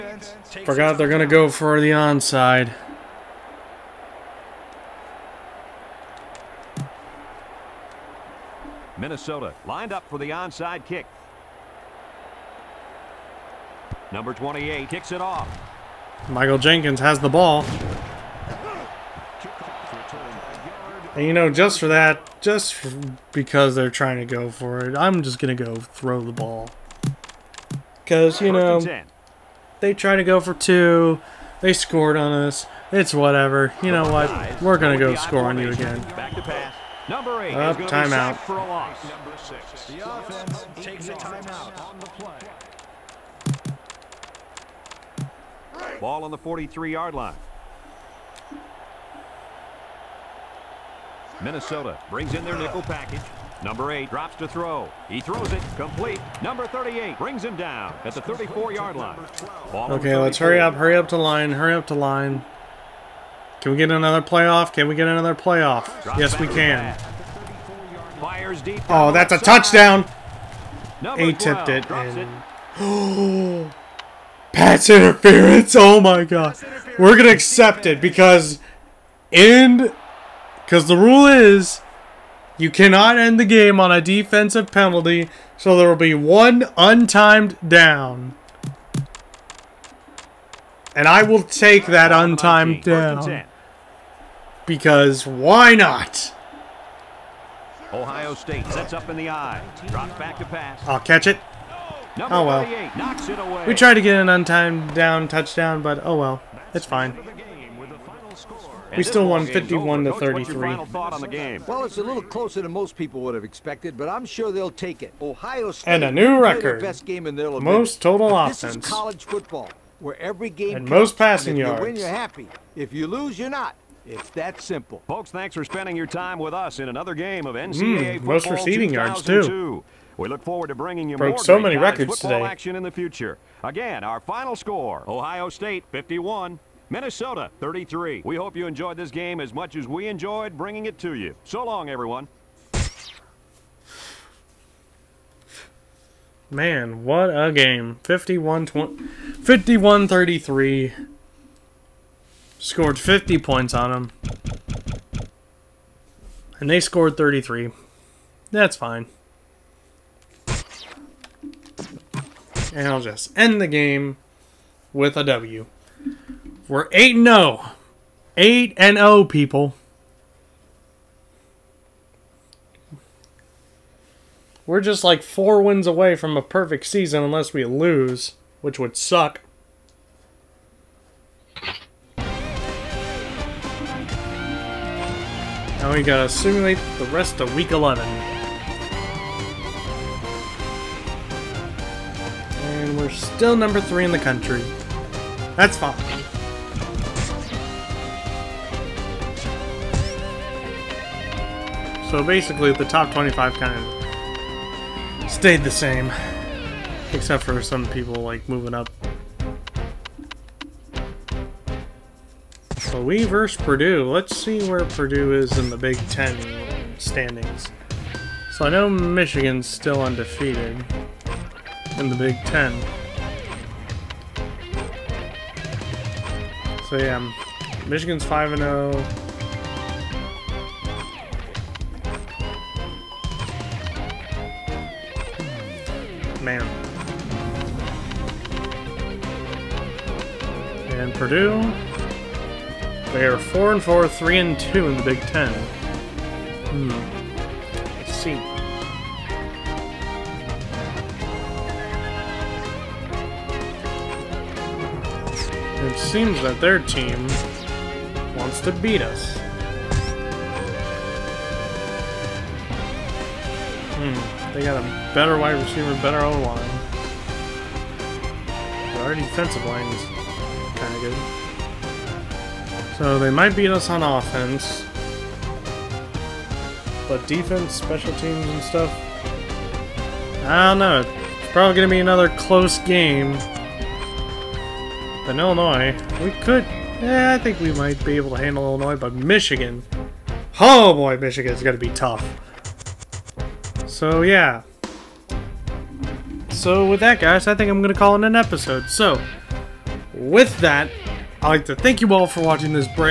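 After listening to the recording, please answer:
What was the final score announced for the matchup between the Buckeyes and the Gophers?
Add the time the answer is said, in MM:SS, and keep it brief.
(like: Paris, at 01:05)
51 to 33, at 01:49.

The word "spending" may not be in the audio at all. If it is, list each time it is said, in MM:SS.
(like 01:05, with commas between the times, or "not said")
02:05.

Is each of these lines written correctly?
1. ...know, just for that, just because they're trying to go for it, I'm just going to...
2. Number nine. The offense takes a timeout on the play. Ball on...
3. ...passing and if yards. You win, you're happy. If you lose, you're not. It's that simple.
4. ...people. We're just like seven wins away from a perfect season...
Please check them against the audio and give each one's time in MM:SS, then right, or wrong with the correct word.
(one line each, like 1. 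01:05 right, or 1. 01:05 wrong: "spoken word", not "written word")
1. 00:21 right
2. 00:39 wrong: "six", not "nine"
3. 02:01 right
4. 02:49 wrong: "four", not "seven".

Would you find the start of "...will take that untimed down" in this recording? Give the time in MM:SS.
01:31.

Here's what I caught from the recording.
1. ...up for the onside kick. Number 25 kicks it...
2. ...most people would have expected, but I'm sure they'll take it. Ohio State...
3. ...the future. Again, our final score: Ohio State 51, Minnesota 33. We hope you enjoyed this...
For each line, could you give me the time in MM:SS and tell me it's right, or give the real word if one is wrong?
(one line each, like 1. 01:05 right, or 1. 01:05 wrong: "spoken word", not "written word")
1. 00:09 wrong: "28", not "25"
2. 01:52 right
3. 02:12 right.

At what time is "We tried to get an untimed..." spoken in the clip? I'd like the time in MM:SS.
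01:43.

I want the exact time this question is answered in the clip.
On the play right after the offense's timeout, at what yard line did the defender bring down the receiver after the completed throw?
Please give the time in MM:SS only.
00:58.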